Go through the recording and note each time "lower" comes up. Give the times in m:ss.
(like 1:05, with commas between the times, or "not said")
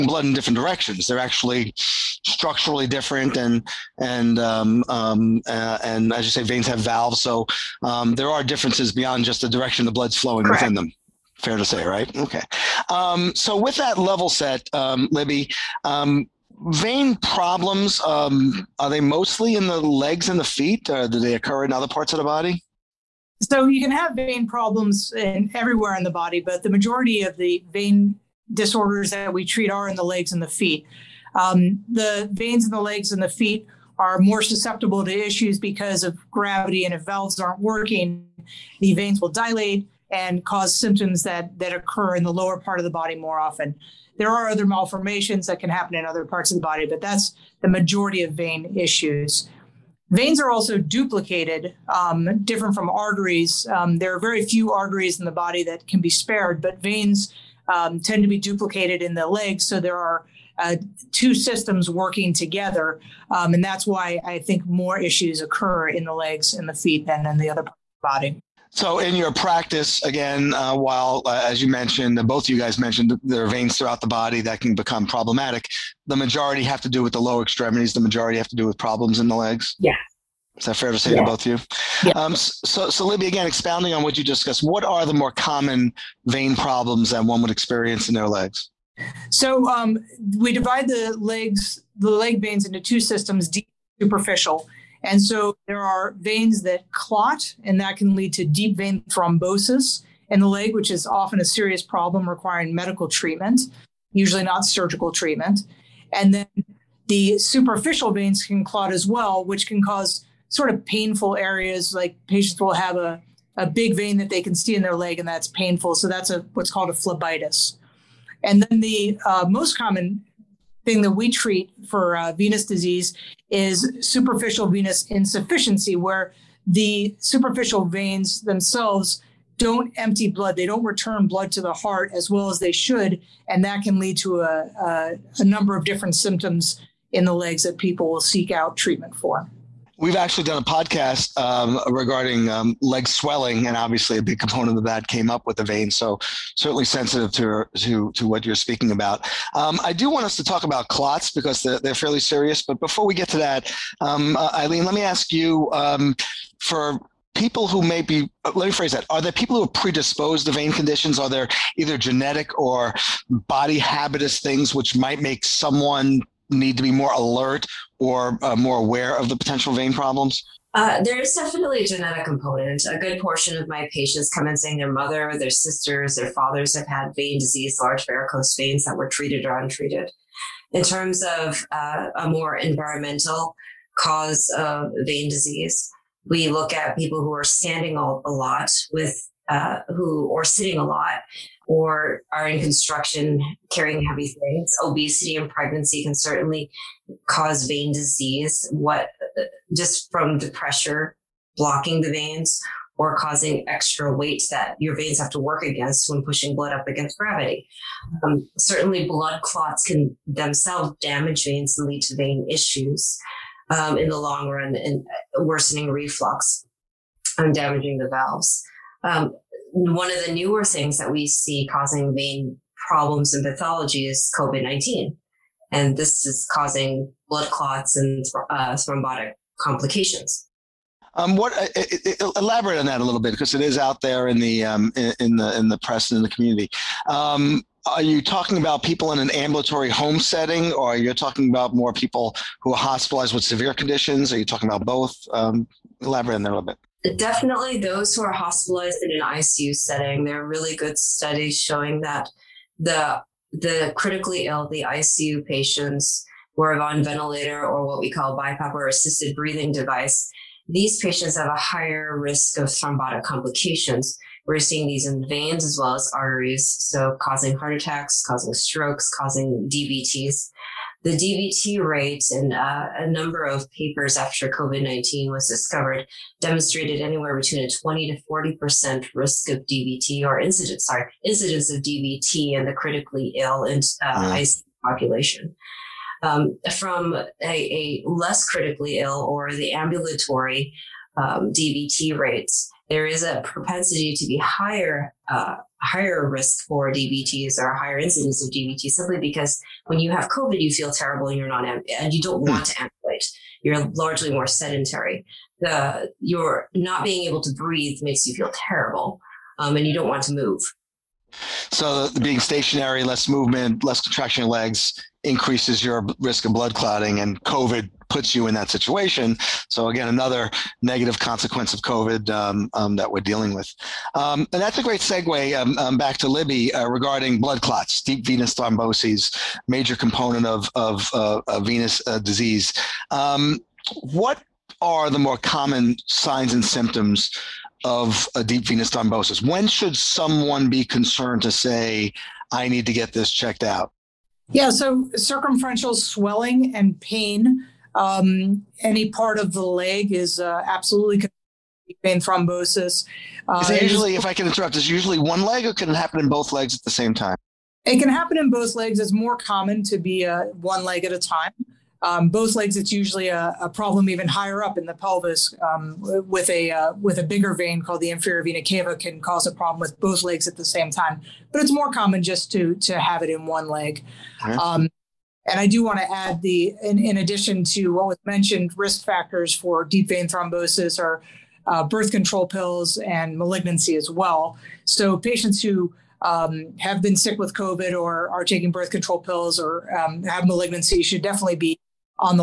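0:42, 1:17.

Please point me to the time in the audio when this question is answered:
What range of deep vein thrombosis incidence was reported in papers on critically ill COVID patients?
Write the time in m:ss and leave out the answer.
4:37.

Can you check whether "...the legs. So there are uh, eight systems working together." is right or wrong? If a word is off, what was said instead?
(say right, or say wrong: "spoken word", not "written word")
wrong: "two", not "eight".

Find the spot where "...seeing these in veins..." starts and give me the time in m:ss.
4:24.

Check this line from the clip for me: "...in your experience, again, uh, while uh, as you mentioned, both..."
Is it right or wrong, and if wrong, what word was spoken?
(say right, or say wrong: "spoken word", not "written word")
wrong: "practice", not "experience".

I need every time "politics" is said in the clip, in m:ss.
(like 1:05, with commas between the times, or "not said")
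not said.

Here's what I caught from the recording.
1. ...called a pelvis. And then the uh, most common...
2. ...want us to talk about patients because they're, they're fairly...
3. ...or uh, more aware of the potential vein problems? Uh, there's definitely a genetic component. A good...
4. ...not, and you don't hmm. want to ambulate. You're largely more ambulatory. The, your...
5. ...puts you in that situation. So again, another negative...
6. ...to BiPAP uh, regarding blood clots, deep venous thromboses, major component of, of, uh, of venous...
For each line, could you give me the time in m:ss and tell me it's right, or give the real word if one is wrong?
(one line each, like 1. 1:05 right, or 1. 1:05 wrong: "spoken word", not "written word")
1. 1:56 wrong: "phlebitis", not "pelvis"
2. 2:30 wrong: "clots", not "patients"
3. 2:47 right
4. 5:01 wrong: "sedentary", not "ambulatory"
5. 5:18 right
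6. 5:26 wrong: "Libby", not "BiPAP".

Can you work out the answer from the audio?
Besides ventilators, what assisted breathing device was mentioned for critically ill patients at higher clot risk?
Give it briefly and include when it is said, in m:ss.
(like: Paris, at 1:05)
BiPAP, at 4:18.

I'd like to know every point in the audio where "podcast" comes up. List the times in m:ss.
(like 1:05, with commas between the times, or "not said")
2:20.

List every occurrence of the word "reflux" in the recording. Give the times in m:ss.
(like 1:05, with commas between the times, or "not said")
3:35.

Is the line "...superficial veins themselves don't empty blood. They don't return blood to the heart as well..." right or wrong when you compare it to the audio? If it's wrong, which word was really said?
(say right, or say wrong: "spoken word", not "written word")
right.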